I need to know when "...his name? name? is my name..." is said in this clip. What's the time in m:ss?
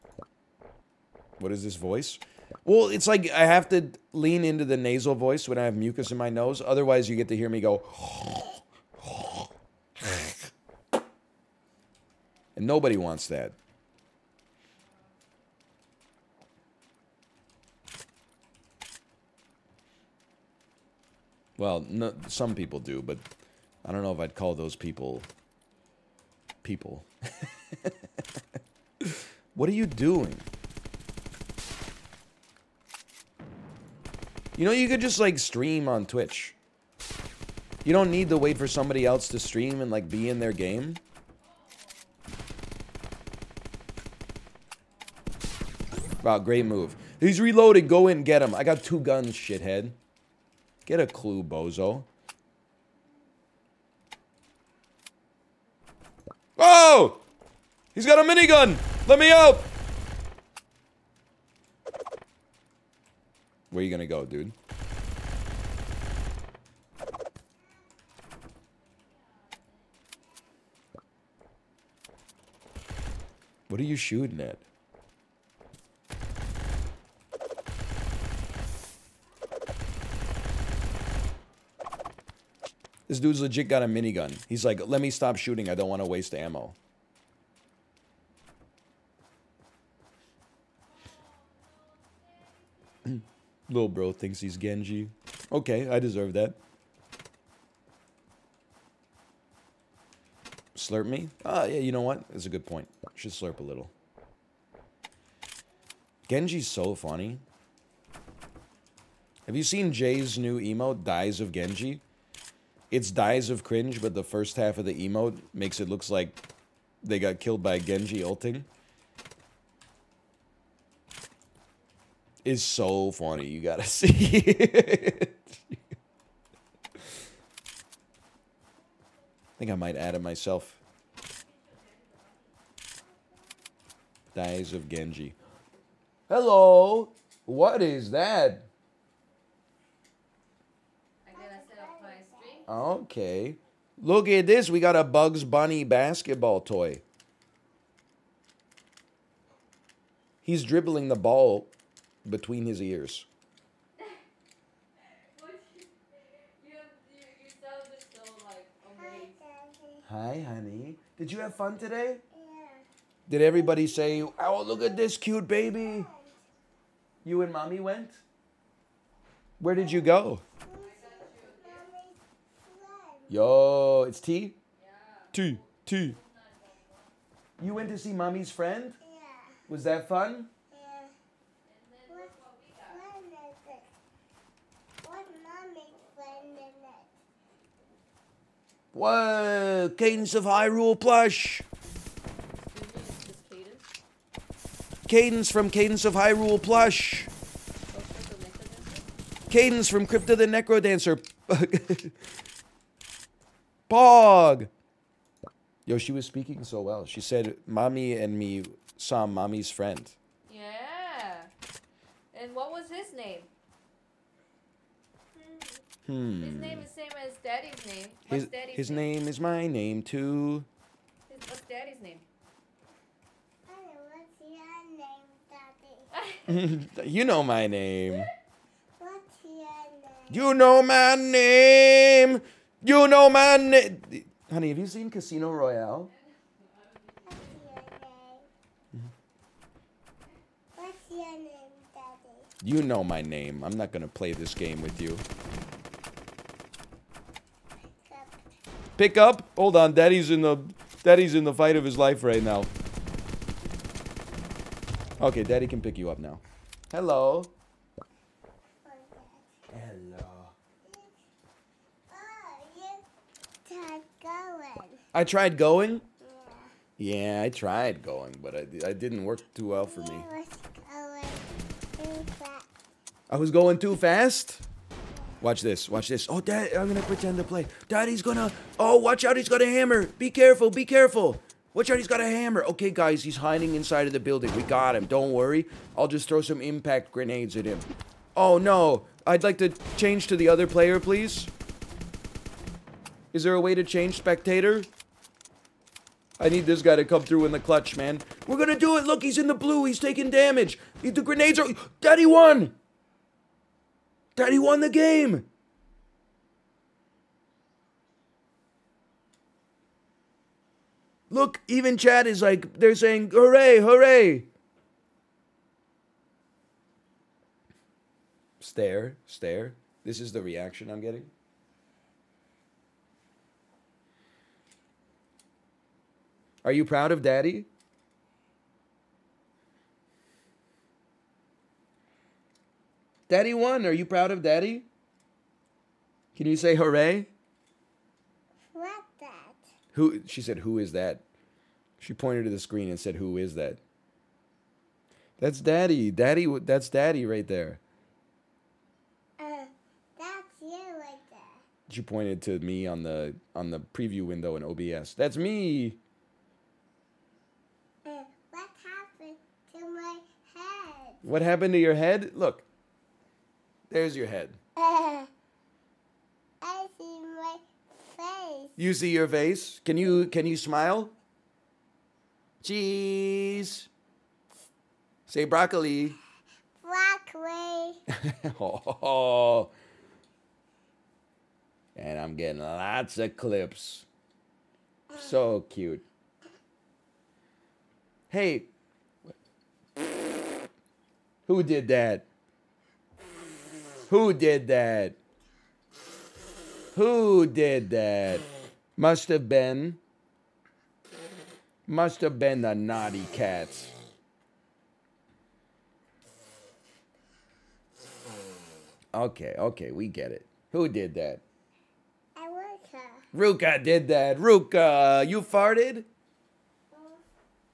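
3:38.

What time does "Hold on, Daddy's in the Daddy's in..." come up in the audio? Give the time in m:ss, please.
4:09.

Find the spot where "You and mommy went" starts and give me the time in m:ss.
2:47.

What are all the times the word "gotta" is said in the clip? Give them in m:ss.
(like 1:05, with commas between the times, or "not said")
2:03.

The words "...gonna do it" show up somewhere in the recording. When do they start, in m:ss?
4:58.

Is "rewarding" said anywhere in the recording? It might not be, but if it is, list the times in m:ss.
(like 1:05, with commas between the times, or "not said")
not said.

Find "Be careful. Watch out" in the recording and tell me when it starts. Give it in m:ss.
4:40.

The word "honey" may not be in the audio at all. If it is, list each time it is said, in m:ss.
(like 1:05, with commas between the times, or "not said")
2:40, 3:54.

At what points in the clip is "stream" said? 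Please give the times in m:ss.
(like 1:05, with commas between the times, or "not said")
0:35, 0:39.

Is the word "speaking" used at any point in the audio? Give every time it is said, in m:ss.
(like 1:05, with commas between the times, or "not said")
3:26.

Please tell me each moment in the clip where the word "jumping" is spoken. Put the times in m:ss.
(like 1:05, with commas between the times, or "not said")
not said.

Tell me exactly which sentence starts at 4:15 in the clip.
Okay, Daddy can pick you up now.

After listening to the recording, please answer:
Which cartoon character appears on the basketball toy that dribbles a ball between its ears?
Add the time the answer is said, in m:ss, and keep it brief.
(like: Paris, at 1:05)
Bugs Bunny, at 2:25.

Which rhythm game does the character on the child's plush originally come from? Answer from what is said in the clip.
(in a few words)
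Crypt of the NecroDancer.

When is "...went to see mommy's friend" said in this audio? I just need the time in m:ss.
2:57.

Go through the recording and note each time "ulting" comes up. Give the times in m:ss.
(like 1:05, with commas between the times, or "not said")
1:58.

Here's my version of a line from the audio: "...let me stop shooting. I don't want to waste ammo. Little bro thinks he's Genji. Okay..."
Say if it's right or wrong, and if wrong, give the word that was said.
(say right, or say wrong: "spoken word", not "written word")
right.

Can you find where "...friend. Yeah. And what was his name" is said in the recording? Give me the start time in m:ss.
3:29.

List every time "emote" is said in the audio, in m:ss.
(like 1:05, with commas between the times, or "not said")
1:50, 1:54.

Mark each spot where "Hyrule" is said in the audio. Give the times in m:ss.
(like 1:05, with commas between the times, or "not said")
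3:10, 3:16.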